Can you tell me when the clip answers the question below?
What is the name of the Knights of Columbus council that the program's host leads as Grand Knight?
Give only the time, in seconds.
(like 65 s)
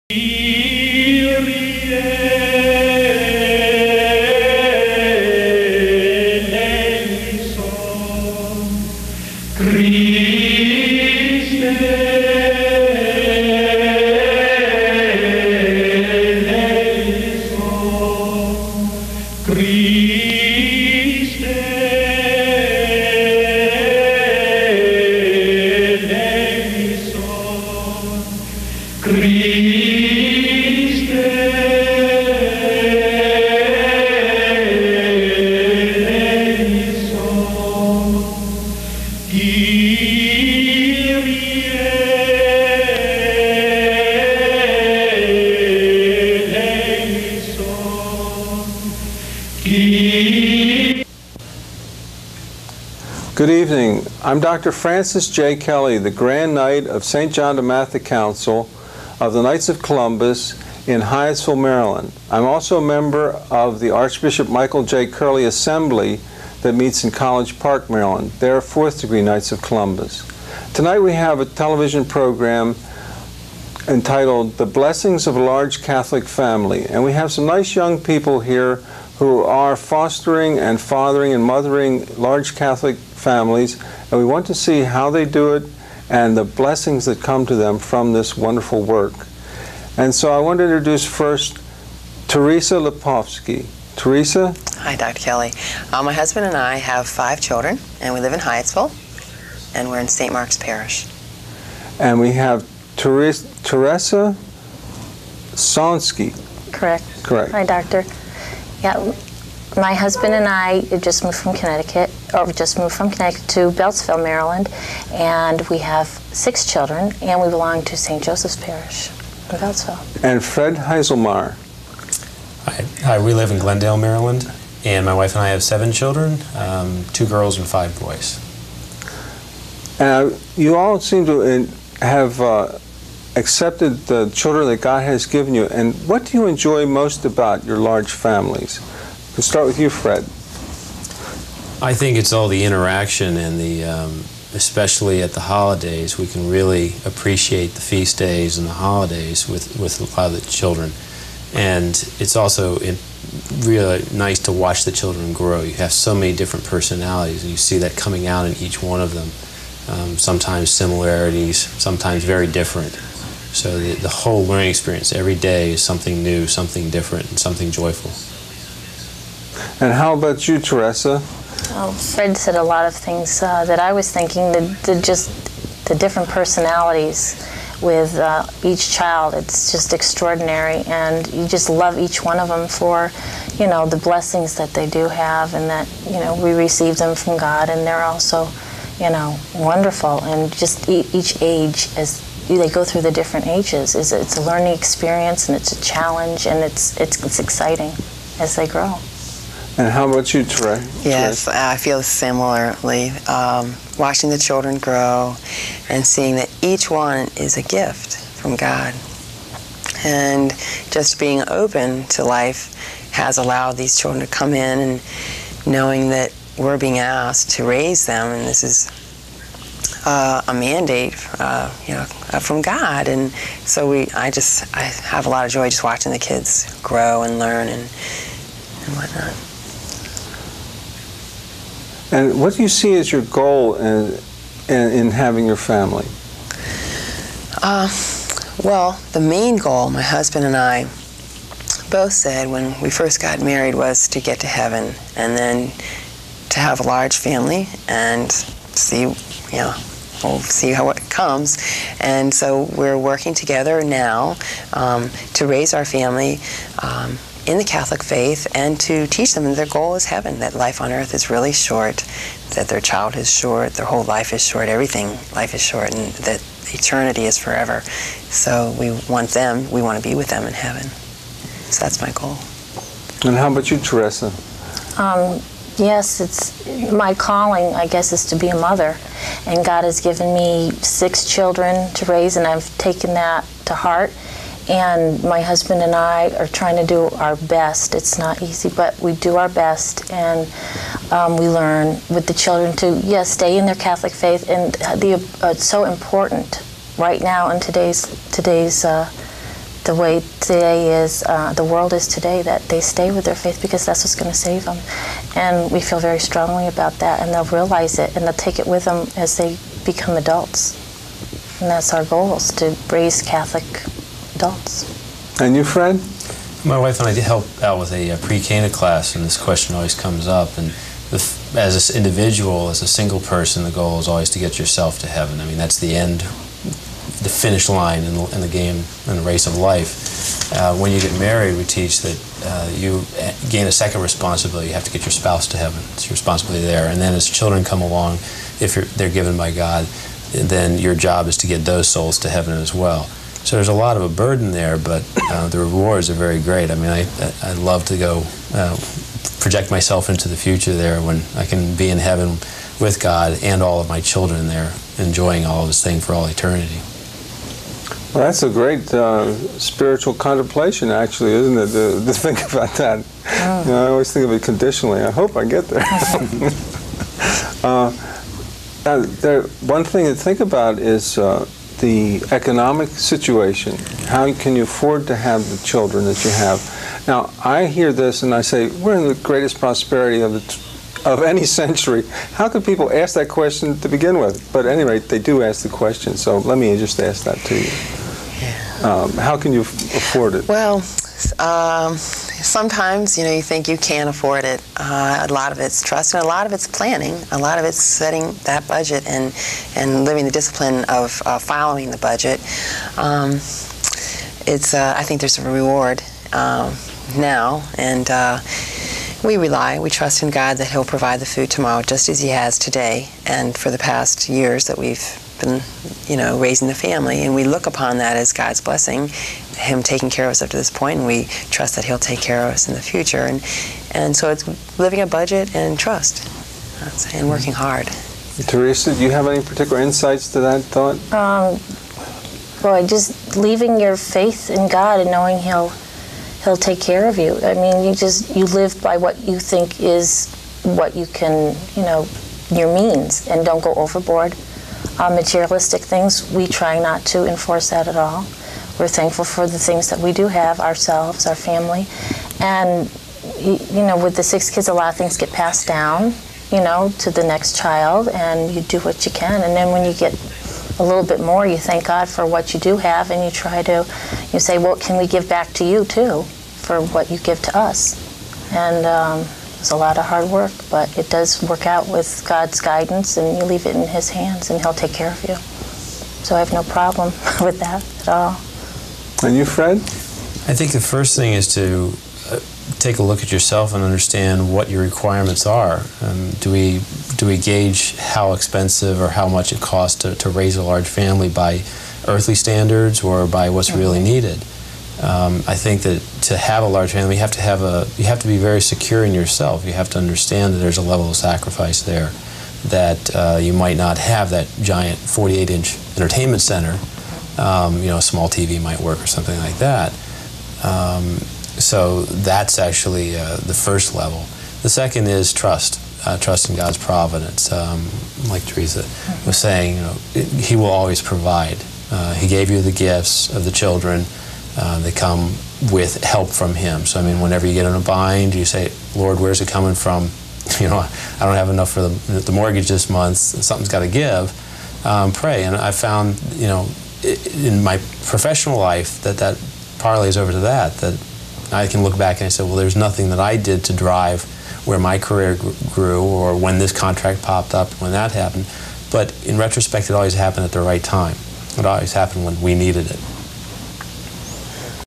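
57 s.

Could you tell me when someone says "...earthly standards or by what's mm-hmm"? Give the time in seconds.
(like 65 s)
492 s.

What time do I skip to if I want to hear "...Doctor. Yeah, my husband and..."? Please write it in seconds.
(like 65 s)
107 s.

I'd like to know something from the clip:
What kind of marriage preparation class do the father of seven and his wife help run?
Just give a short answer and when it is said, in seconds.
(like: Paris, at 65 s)
pre-cana class, at 318 s.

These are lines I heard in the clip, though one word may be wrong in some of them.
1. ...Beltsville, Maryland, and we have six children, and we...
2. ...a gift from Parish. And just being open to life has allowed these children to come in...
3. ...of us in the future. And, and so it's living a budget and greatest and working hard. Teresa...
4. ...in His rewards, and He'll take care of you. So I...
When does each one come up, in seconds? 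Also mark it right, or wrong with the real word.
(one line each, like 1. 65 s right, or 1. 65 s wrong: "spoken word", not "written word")
1. 113 s right
2. 207 s wrong: "God", not "Parish"
3. 422 s wrong: "trust", not "greatest"
4. 473 s wrong: "hands", not "rewards".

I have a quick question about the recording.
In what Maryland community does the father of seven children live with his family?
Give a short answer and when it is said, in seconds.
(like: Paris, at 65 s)
Glendale, at 123 s.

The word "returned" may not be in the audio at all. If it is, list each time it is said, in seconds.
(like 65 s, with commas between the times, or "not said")
not said.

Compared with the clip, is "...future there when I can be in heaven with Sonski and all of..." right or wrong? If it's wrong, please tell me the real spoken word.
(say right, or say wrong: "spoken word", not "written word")
wrong: "God", not "Sonski".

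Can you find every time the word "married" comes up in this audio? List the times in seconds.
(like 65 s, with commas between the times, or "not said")
243 s, 331 s.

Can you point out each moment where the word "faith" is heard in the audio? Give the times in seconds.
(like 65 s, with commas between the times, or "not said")
258 s, 294 s, 303 s, 433 s.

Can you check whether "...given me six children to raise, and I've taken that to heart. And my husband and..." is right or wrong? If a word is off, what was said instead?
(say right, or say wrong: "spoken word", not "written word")
right.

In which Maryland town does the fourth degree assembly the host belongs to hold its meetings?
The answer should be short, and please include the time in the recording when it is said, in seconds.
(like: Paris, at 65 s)
College Park, at 67 s.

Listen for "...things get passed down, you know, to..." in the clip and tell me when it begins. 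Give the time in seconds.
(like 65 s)
454 s.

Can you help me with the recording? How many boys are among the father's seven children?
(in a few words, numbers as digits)
5.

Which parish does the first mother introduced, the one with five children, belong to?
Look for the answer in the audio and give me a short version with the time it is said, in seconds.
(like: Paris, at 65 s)
St. Mark's Parish, at 100 s.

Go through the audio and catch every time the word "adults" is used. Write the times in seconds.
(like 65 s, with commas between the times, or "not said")
310 s, 314 s.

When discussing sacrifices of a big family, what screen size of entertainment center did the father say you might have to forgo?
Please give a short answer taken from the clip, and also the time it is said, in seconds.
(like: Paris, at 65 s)
48-inch, at 504 s.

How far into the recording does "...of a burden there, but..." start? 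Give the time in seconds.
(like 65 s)
343 s.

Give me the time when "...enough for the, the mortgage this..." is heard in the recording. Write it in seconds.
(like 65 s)
531 s.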